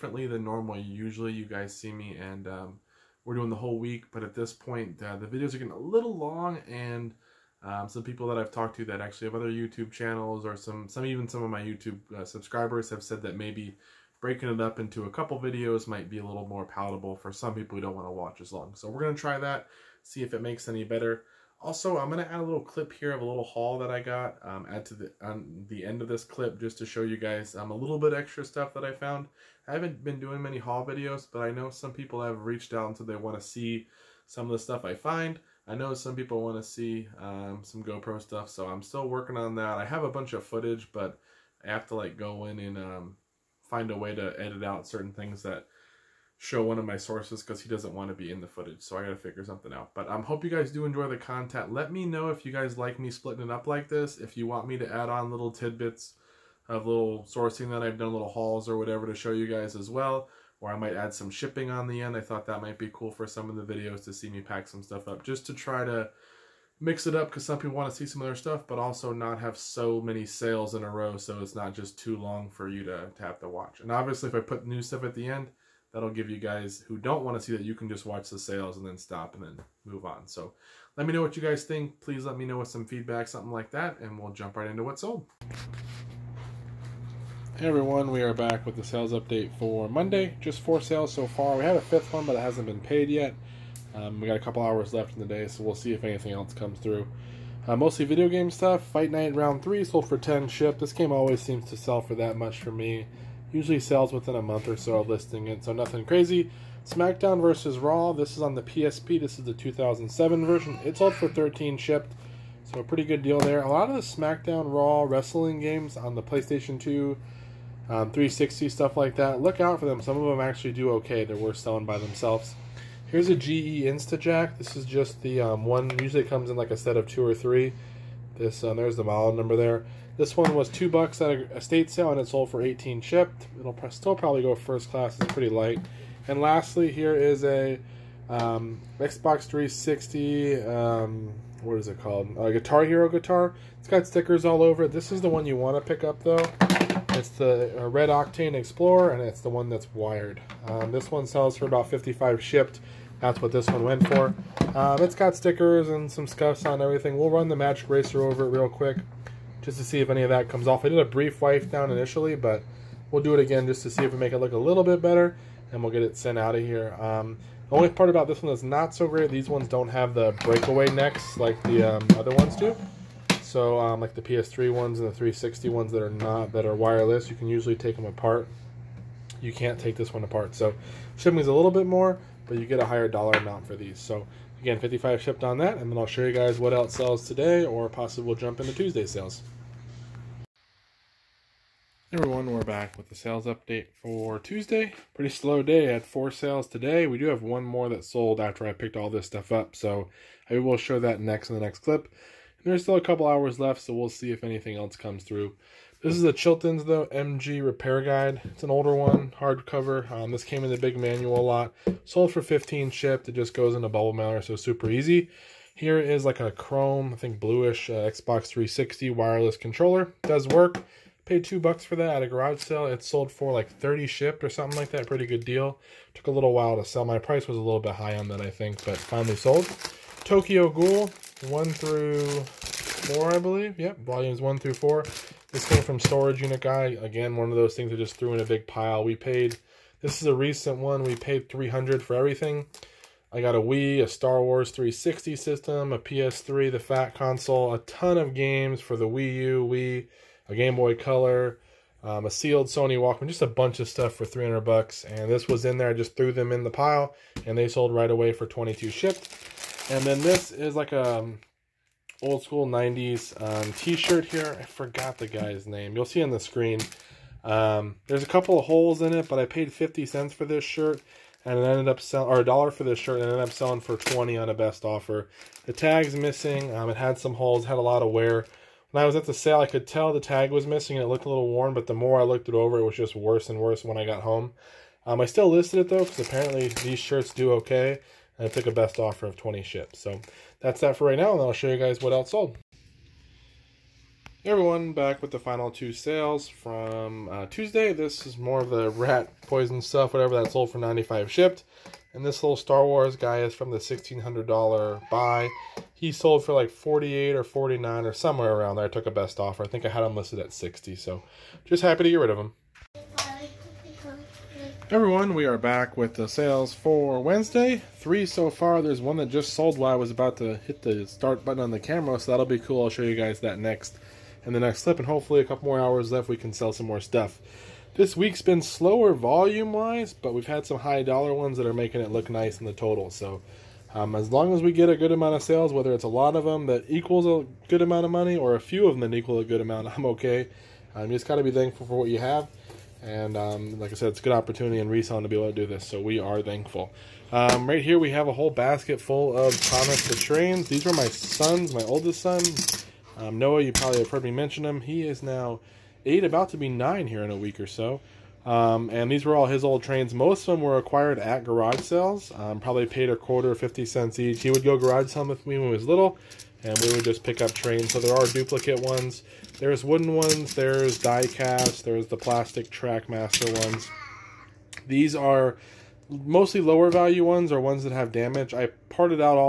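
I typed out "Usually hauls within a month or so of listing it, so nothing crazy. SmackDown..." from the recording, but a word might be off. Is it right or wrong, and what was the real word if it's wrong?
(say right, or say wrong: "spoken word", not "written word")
wrong: "sells", not "hauls".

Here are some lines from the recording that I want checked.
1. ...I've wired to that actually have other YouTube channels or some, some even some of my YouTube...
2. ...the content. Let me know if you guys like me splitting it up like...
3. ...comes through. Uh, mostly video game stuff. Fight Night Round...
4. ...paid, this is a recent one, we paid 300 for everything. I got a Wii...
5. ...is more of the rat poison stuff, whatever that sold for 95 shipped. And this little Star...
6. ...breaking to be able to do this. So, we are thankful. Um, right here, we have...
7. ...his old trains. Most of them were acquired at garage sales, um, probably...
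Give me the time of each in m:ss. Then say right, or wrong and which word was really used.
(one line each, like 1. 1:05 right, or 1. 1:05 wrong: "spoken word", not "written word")
1. 0:08 wrong: "talked", not "wired"
2. 0:51 right
3. 1:36 right
4. 3:59 right
5. 4:58 right
6. 5:44 wrong: "reselling", not "breaking"
7. 5:59 right.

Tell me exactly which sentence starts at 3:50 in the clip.
Tokyo Ghoul, 1 through 4, I believe.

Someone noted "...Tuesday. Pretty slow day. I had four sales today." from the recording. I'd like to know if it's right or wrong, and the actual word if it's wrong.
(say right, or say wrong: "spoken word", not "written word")
right.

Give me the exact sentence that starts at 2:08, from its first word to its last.
This um, there's the model number there.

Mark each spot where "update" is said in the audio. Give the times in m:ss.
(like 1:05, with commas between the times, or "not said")
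1:29, 3:13.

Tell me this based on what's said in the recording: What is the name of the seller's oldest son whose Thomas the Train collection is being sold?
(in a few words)
Noah.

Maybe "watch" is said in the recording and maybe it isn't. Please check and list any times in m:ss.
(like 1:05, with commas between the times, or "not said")
0:18, 1:13, 1:18.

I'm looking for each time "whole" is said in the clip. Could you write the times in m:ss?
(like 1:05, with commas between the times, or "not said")
0:03, 5:48.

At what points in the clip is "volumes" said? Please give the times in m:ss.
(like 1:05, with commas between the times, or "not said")
3:54, 5:29.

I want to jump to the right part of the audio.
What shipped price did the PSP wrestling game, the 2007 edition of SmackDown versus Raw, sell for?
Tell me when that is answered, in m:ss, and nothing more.
1:51.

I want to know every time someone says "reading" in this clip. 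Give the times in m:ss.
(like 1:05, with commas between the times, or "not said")
not said.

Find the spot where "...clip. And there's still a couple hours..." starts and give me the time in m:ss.
3:21.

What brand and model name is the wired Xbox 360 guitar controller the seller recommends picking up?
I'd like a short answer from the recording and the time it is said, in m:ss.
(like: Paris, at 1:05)
Red Octane Explorer, at 2:27.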